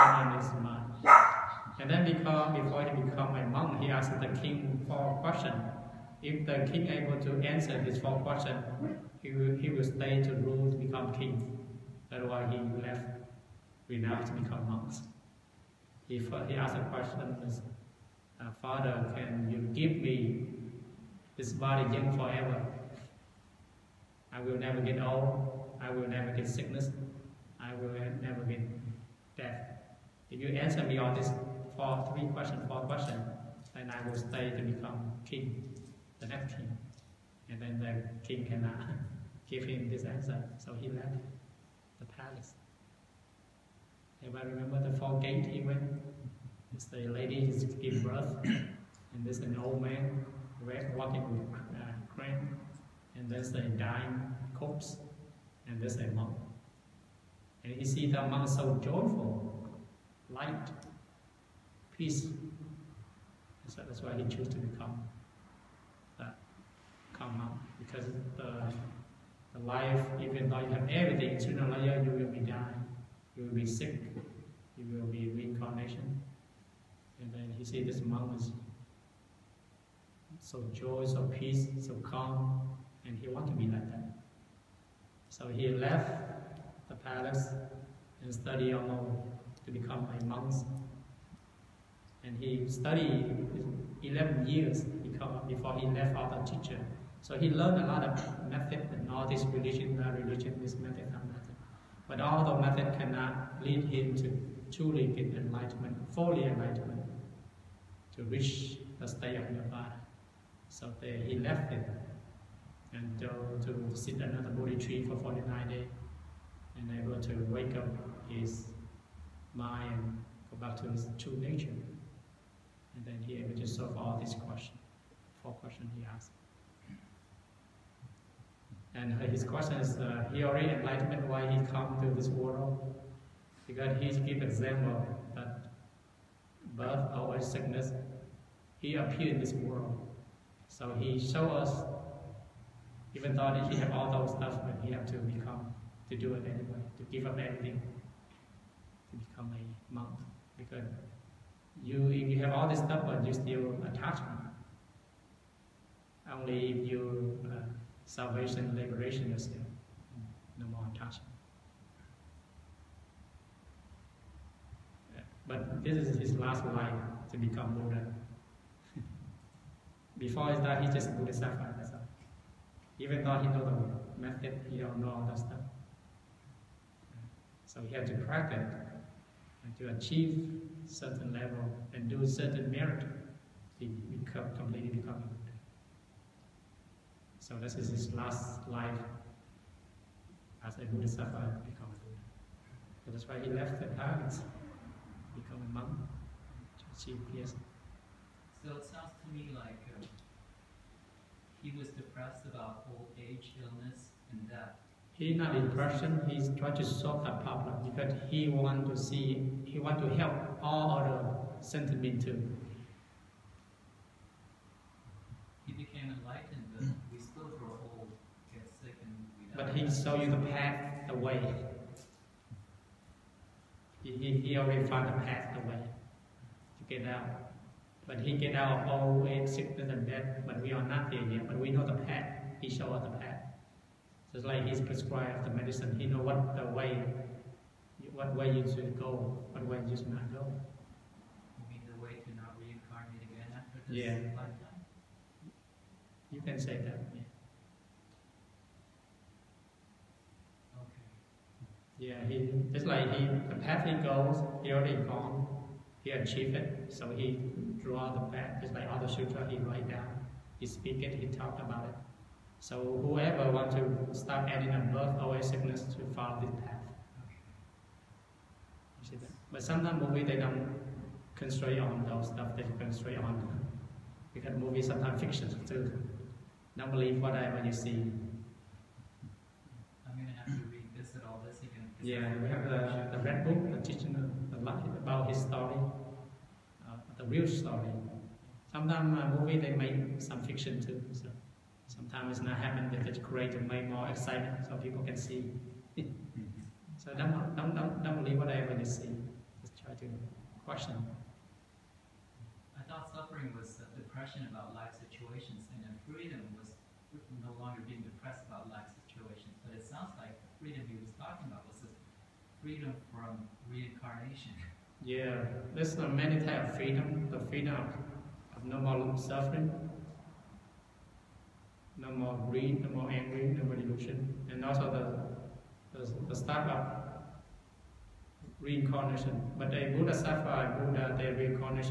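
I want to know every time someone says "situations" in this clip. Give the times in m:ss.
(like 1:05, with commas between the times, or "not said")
5:04, 5:09.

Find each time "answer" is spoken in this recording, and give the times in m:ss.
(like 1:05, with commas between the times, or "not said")
0:07, 0:30, 0:40.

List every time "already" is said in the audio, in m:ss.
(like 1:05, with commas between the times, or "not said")
2:10, 3:44, 4:14.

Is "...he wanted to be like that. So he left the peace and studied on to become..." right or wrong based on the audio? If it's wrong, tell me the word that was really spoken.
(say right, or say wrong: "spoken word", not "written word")
wrong: "palace", not "peace".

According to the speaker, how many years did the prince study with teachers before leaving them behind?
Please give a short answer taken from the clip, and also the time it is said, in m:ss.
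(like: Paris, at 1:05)
11, at 1:34.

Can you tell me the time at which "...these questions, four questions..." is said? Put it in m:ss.
2:04.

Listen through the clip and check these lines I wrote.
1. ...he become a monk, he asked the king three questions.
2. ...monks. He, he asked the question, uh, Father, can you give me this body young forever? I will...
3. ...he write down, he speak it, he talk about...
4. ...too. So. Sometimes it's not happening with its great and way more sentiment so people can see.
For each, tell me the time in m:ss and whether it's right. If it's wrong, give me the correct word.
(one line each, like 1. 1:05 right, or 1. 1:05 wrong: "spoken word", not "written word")
1. 0:02 wrong: "four", not "three"
2. 0:14 right
3. 4:19 right
4. 4:50 wrong: "excitement", not "sentiment".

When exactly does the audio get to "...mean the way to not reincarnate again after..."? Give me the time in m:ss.
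4:01.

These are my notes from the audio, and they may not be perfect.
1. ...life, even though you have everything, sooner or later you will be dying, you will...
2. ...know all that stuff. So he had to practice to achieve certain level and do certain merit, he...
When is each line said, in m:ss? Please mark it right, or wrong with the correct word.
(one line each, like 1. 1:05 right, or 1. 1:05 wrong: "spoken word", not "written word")
1. 1:09 right
2. 2:54 right.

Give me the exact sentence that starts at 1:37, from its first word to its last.
So he learned a lot of method and all this religion, that religion, this method, that method.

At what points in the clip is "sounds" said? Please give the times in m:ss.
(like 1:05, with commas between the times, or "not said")
3:18, 5:09.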